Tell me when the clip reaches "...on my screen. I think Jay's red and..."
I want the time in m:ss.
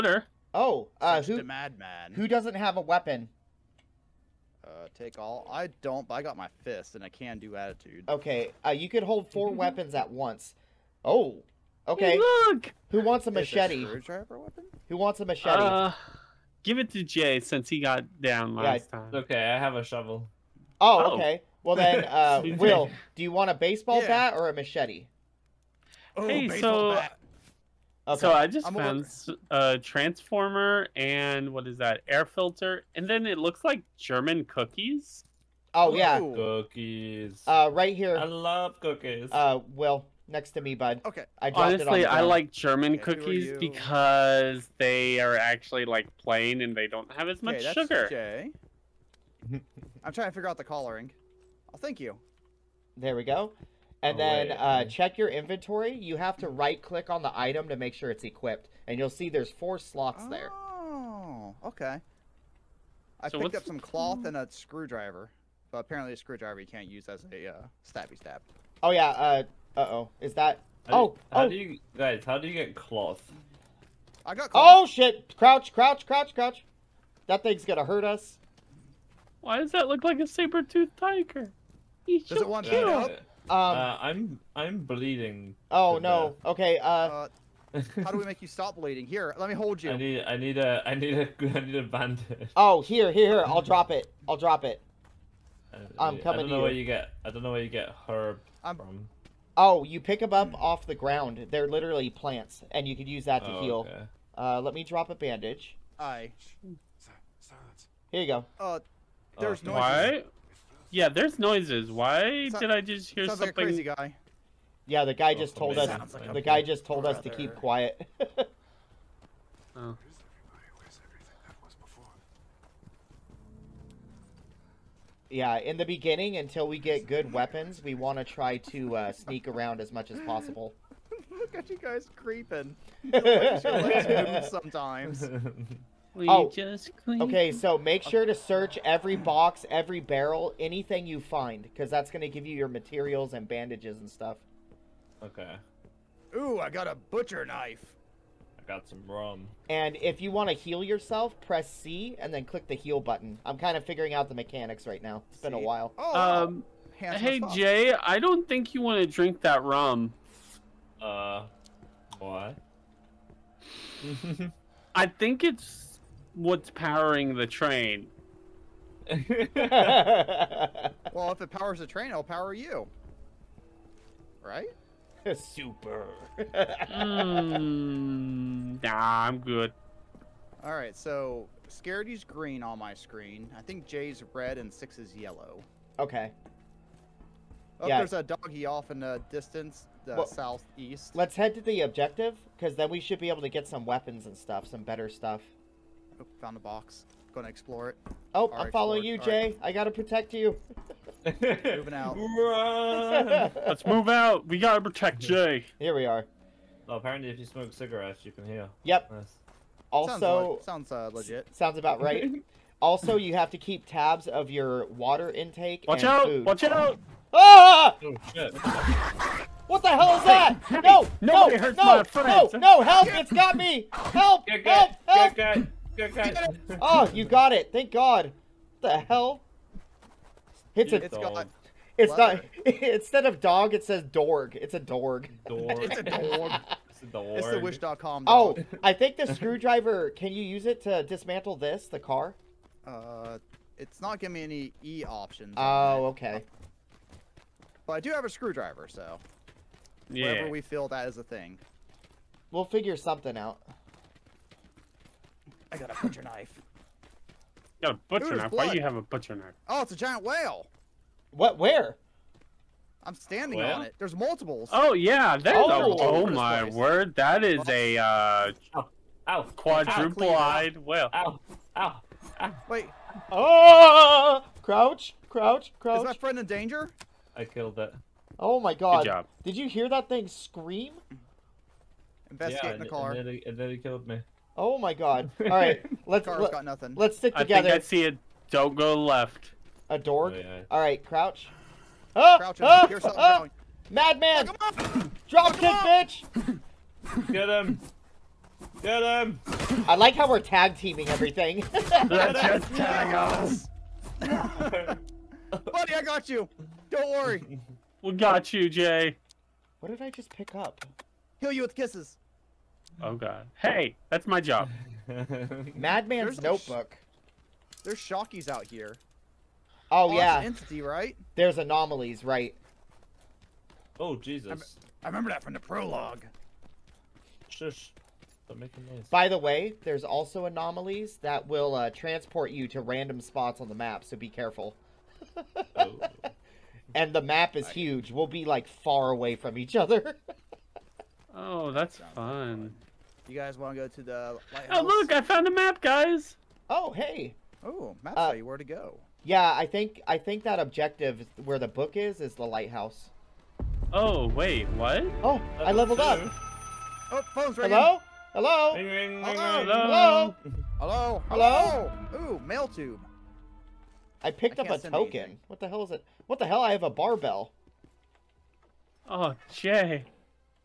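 3:02.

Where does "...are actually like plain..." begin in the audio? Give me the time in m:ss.
0:45.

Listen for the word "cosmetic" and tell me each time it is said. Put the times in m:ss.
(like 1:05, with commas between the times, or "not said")
not said.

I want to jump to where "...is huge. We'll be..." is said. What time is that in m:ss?
5:37.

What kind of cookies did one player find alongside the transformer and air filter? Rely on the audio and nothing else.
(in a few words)
German cookies.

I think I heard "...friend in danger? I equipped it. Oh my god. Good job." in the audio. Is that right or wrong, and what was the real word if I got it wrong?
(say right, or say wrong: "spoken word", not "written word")
wrong: "killed", not "equipped".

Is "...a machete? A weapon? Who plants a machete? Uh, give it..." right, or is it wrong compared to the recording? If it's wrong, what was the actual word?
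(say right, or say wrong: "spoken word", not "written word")
wrong: "wants", not "plants".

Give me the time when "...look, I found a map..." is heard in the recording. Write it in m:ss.
5:44.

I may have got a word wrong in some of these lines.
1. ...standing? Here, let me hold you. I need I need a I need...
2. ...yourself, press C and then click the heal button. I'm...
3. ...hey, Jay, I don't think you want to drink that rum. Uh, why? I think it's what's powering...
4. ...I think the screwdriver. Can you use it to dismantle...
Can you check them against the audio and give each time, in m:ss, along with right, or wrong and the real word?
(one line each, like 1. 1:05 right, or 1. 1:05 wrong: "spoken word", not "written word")
1. 1:28 wrong: "bleeding", not "standing"
2. 2:30 right
3. 2:36 right
4. 3:58 right.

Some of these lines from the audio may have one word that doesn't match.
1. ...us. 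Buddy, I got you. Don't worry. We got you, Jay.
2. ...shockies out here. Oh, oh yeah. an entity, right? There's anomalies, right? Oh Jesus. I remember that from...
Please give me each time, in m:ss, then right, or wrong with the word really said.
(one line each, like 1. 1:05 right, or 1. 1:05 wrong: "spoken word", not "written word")
1. 5:03 right
2. 5:17 right.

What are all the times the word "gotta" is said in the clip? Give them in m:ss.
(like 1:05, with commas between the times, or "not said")
3:19, 3:24.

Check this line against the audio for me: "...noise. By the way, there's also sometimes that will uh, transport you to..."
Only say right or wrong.
wrong.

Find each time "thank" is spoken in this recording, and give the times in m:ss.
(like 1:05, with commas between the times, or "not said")
0:51, 3:47.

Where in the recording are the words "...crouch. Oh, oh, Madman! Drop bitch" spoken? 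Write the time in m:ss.
4:52.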